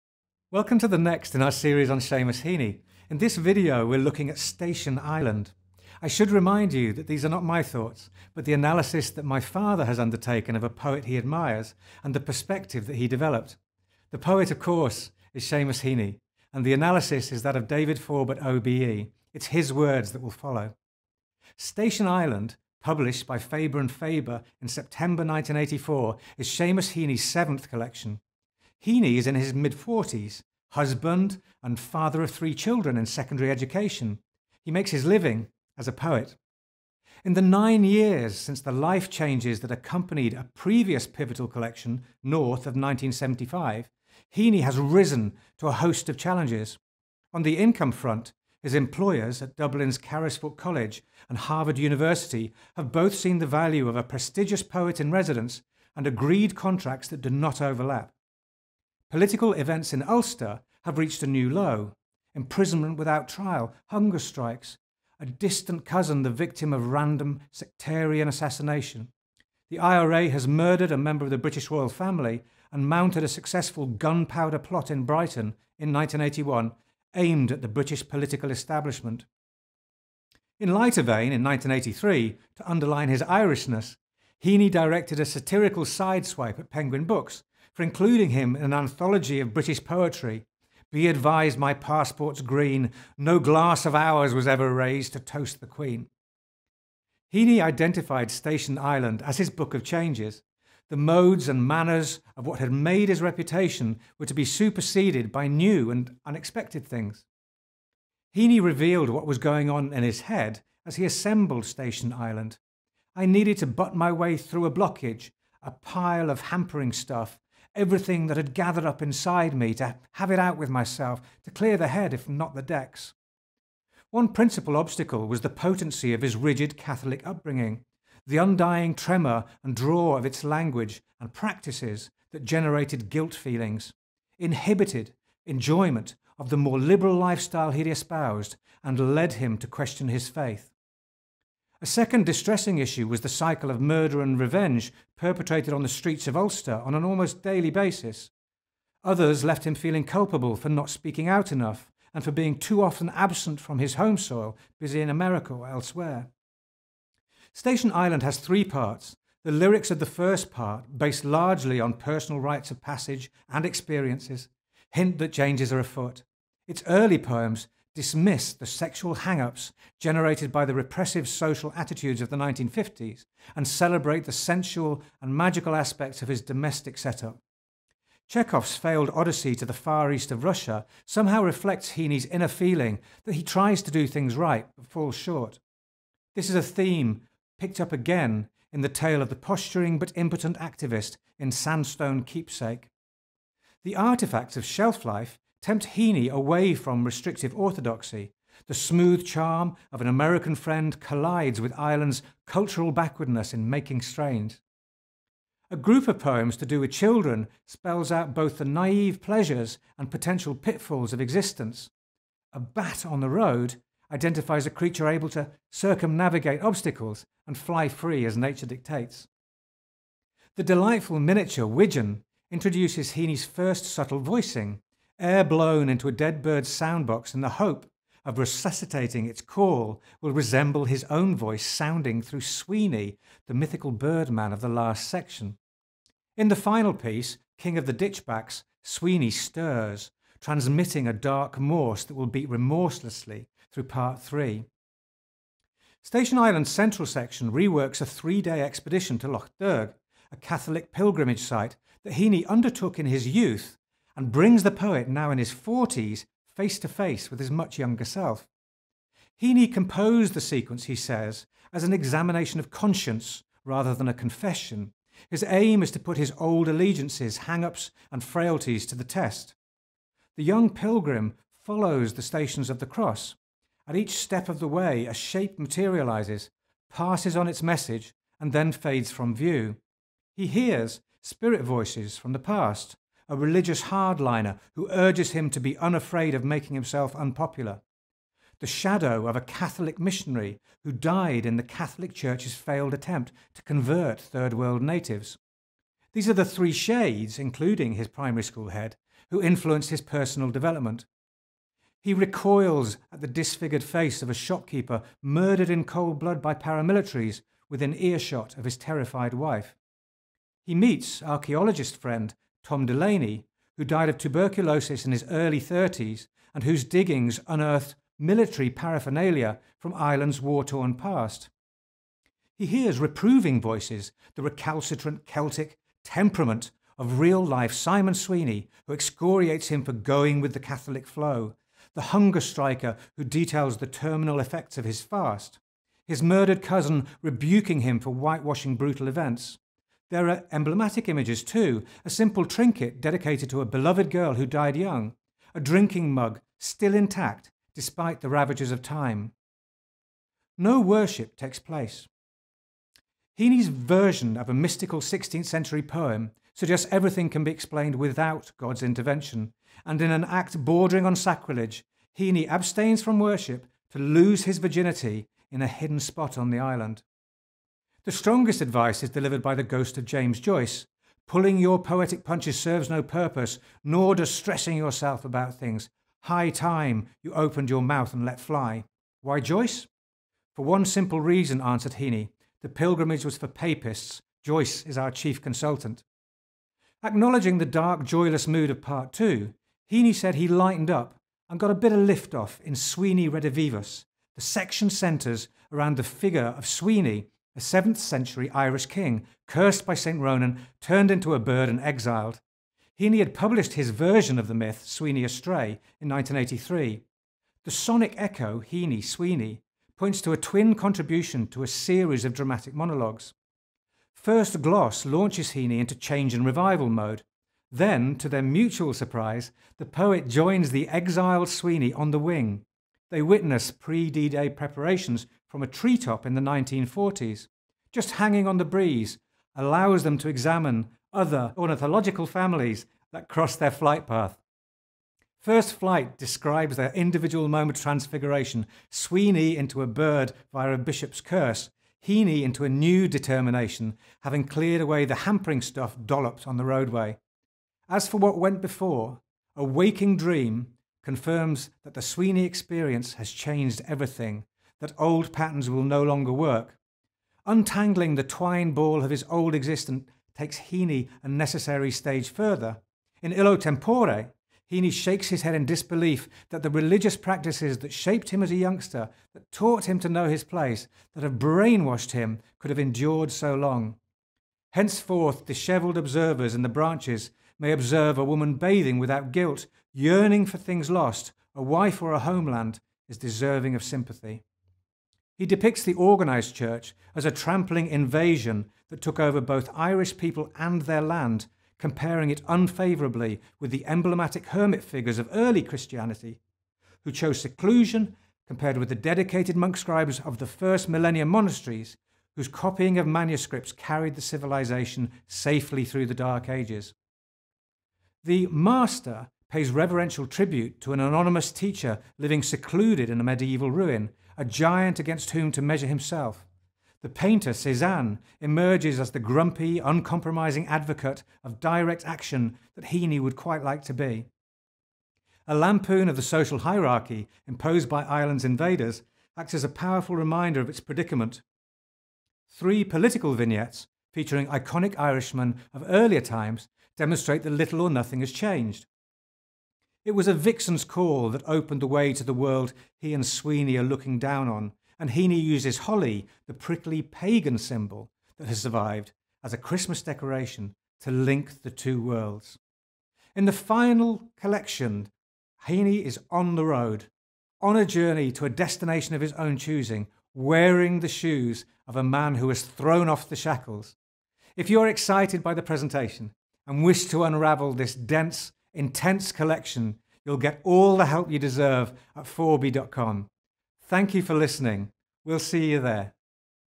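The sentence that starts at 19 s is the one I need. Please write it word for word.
It's his words that will follow.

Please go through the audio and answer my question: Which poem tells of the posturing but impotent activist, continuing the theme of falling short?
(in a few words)
Sandstone Keepsake.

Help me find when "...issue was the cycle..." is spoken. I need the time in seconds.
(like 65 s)
142 s.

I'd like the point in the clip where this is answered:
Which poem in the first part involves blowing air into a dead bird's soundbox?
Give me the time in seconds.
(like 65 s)
221 s.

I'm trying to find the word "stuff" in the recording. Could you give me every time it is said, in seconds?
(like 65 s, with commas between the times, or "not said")
116 s, 445 s.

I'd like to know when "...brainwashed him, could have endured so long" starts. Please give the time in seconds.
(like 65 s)
471 s.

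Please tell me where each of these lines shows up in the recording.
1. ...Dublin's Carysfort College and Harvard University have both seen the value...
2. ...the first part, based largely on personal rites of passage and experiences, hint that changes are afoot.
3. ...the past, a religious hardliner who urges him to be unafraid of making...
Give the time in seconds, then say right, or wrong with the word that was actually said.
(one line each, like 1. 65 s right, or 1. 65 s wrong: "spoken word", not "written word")
1. 49 s right
2. 159 s right
3. 282 s right.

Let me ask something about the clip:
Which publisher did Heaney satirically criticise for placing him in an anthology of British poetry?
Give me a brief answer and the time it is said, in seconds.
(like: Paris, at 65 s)
Penguin Books, at 86 s.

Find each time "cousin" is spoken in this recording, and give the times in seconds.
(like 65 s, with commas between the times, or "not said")
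65 s, 336 s.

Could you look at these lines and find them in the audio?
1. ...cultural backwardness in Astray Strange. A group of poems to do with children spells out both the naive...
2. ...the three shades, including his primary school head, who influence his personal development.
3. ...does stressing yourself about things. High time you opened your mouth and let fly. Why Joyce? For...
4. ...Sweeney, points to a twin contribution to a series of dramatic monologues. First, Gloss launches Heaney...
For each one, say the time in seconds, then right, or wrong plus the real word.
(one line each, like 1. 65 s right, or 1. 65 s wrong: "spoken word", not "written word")
1. 202 s wrong: "Making", not "Astray"
2. 296 s right
3. 374 s right
4. 409 s right.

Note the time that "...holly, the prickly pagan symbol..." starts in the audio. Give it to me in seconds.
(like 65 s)
545 s.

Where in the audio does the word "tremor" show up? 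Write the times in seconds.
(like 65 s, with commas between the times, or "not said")
128 s.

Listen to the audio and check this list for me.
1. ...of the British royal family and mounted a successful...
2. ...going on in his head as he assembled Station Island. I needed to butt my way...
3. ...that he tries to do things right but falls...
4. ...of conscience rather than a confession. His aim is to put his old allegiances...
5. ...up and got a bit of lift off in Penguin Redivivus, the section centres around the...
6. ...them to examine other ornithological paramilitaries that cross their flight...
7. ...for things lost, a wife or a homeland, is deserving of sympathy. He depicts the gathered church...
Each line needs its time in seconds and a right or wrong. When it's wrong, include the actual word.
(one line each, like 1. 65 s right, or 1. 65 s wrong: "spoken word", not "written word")
1. 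71 s right
2. 109 s right
3. 183 s right
4. 262 s right
5. 390 s wrong: "Sweeney", not "Penguin"
6. 430 s wrong: "families", not "paramilitaries"
7. 480 s wrong: "organised", not "gathered".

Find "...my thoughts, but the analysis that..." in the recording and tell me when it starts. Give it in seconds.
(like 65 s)
7 s.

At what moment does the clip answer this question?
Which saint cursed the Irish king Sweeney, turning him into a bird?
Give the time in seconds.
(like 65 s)
399 s.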